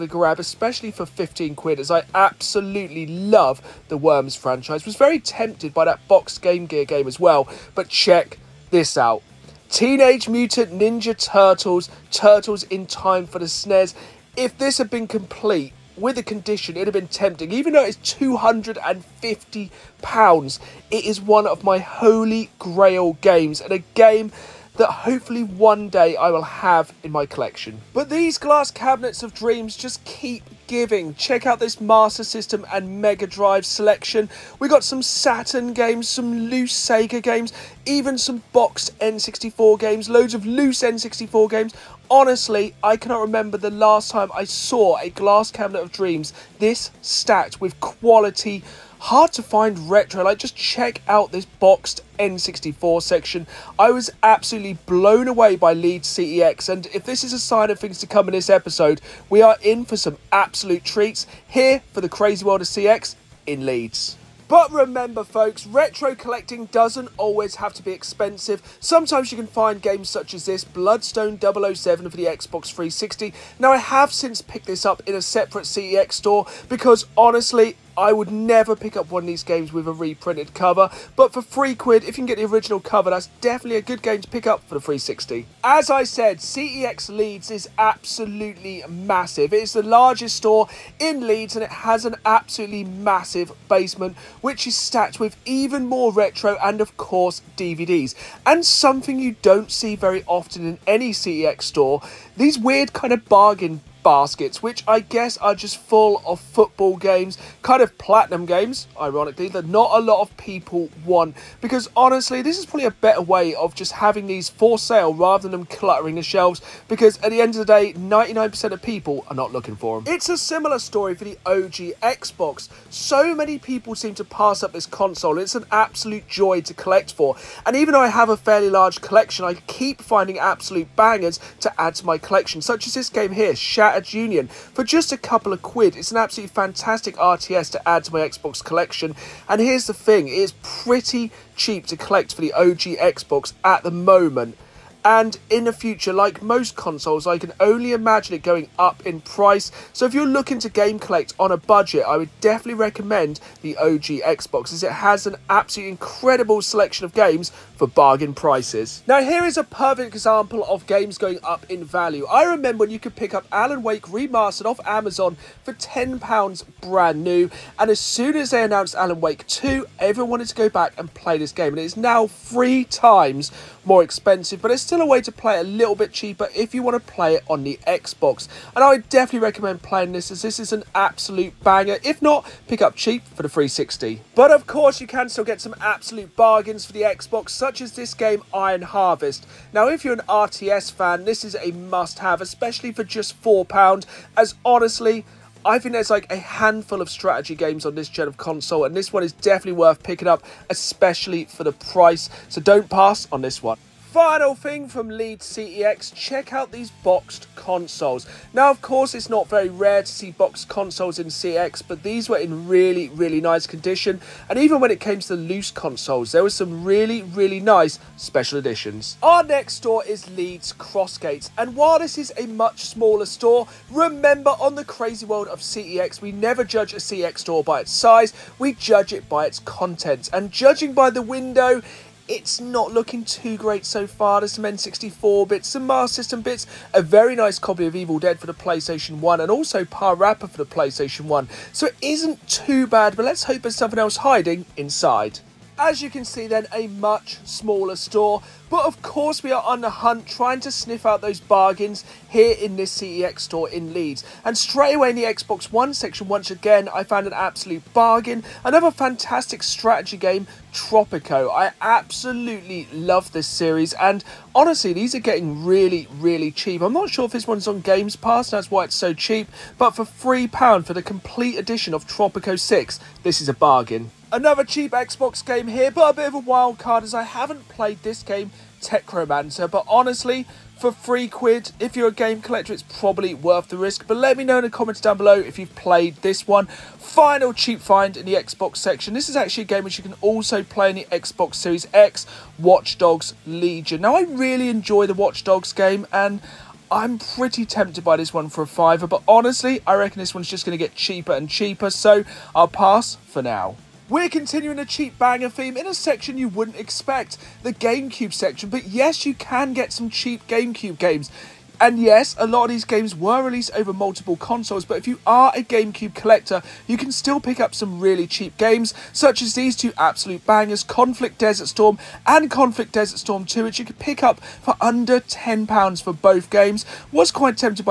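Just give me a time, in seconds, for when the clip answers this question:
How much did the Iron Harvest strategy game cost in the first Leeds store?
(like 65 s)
193 s.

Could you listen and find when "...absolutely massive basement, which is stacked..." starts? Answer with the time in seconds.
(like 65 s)
92 s.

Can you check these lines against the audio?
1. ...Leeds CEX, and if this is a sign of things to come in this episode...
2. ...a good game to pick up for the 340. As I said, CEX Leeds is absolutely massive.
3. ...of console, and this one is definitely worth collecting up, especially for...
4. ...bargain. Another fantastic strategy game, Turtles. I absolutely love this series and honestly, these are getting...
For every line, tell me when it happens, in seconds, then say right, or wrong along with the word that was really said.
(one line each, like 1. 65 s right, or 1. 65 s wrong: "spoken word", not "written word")
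1. 55 s right
2. 83 s wrong: "360", not "340"
3. 198 s wrong: "picking", not "collecting"
4. 257 s wrong: "Tropico", not "Turtles".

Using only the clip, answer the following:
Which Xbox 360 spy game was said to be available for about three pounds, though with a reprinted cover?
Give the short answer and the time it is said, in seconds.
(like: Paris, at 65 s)
Blood Stone 007, at 70 s.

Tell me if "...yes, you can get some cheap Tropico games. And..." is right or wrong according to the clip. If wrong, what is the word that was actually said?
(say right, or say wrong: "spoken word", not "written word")
wrong: "GameCube", not "Tropico".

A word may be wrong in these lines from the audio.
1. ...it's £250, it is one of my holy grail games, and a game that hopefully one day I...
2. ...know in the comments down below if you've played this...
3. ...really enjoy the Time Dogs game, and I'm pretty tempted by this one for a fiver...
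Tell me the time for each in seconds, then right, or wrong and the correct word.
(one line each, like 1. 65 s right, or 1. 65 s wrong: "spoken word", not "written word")
1. 17 s right
2. 284 s right
3. 294 s wrong: "Watch", not "Time".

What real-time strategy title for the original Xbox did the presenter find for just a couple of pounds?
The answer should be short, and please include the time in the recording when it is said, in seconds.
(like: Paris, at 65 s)
Shattered Union, at 133 s.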